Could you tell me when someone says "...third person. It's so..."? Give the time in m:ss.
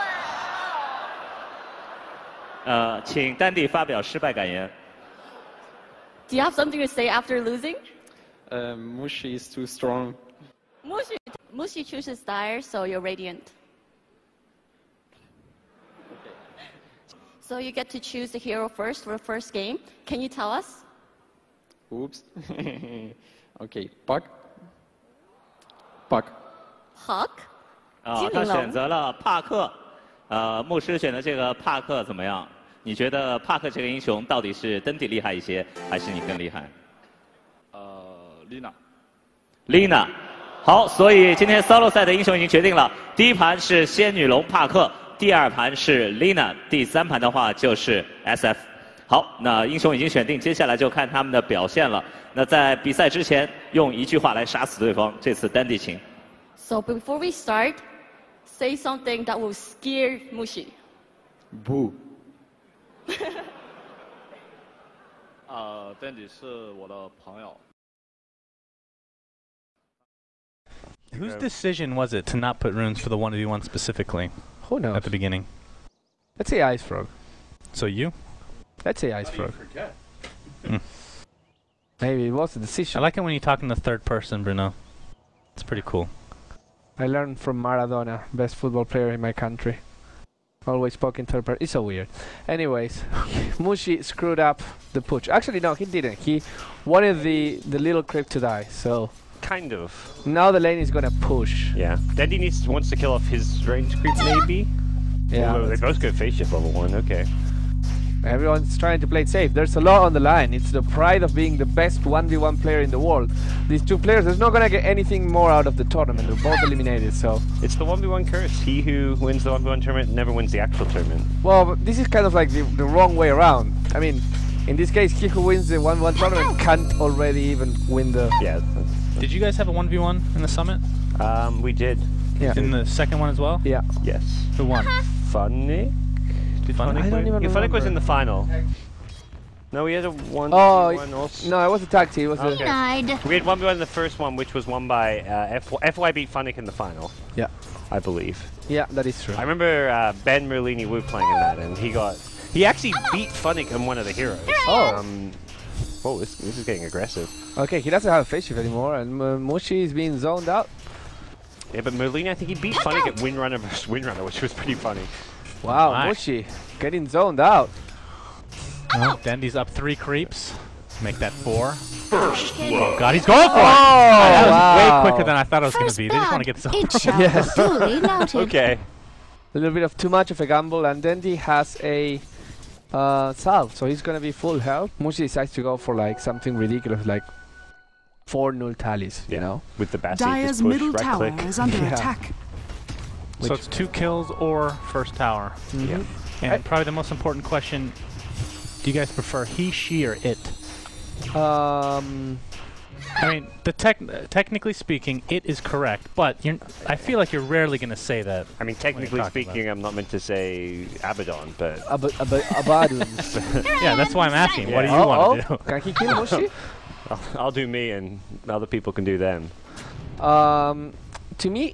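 1:31.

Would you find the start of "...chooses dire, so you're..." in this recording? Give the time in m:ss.
0:11.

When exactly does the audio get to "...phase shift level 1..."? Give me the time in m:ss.
1:46.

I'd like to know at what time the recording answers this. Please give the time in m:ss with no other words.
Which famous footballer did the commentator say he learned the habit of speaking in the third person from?
1:27.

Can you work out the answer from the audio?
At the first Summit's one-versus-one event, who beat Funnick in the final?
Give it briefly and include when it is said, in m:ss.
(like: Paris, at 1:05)
FY, at 2:25.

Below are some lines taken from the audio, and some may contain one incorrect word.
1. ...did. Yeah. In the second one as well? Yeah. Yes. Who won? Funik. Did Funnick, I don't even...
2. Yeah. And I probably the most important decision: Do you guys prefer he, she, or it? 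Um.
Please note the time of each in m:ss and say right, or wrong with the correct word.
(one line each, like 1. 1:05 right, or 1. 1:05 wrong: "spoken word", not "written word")
1. 2:11 right
2. 3:15 wrong: "question", not "decision".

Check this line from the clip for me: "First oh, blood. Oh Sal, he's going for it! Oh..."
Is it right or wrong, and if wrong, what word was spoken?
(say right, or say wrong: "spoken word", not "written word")
wrong: "God", not "Sal".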